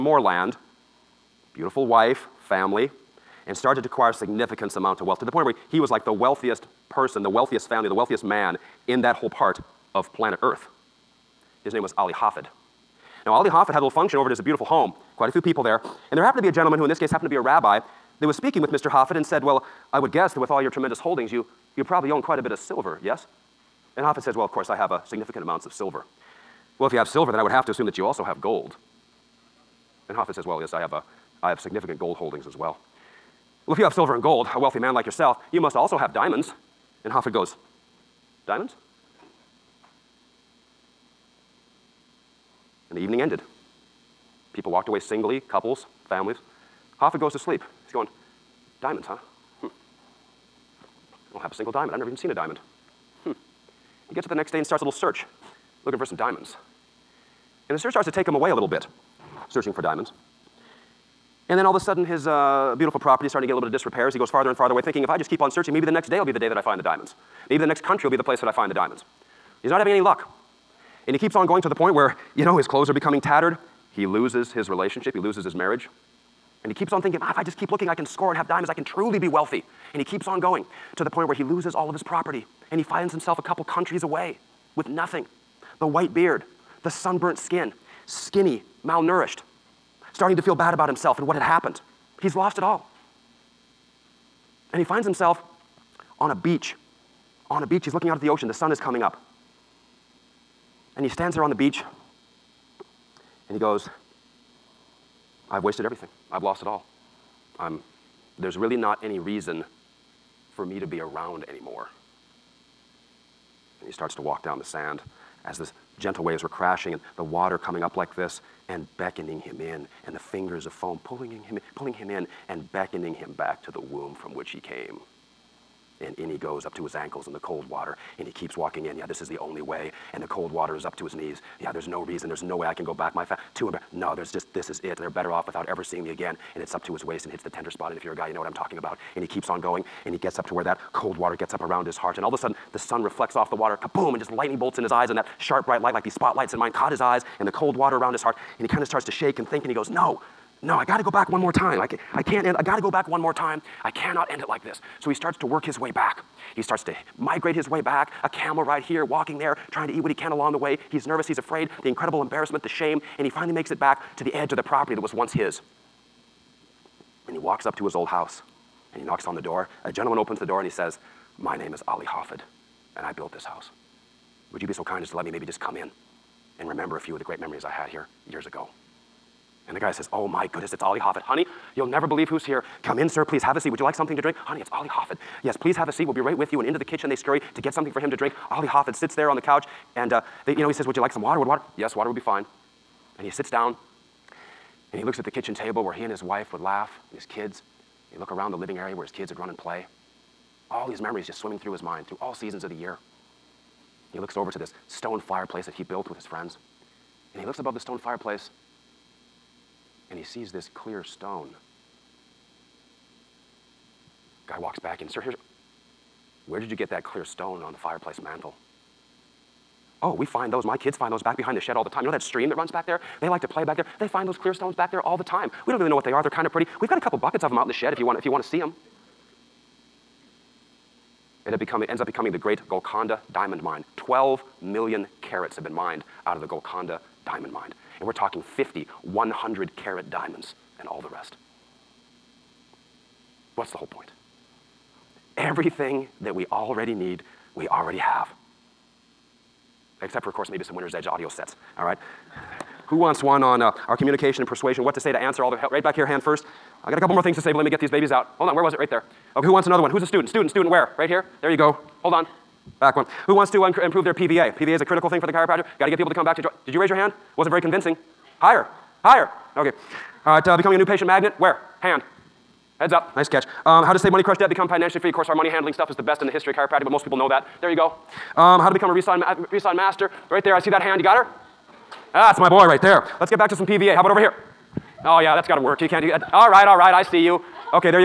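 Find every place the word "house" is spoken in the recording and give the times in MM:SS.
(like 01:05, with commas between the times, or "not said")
02:48, 02:53.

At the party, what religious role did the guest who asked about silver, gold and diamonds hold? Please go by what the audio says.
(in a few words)
rabbi.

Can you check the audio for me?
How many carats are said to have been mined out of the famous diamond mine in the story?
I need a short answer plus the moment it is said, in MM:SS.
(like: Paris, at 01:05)
12 million carats, at 03:53.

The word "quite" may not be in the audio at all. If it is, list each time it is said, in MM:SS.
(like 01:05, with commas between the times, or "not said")
00:15, 00:22.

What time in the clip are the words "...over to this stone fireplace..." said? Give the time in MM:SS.
03:24.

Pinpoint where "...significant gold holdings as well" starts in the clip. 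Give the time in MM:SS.
00:31.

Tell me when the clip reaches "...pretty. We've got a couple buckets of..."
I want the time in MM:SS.
03:46.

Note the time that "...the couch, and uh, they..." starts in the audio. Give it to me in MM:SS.
03:09.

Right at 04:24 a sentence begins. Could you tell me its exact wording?
PVA is a critical thing for the chiropractor.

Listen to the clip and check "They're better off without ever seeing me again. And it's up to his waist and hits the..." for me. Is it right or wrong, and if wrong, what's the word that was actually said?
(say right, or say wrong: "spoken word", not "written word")
right.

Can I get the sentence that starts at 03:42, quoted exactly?
You know that stream that runs back there?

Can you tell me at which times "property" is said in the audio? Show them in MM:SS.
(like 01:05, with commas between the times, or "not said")
01:02, 01:22, 02:44.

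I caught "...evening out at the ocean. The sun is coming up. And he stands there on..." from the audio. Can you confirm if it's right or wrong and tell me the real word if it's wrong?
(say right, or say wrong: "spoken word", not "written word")
wrong: "looking", not "evening".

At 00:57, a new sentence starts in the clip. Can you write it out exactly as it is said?
And the search starts to take him away a little bit, searching for diamonds.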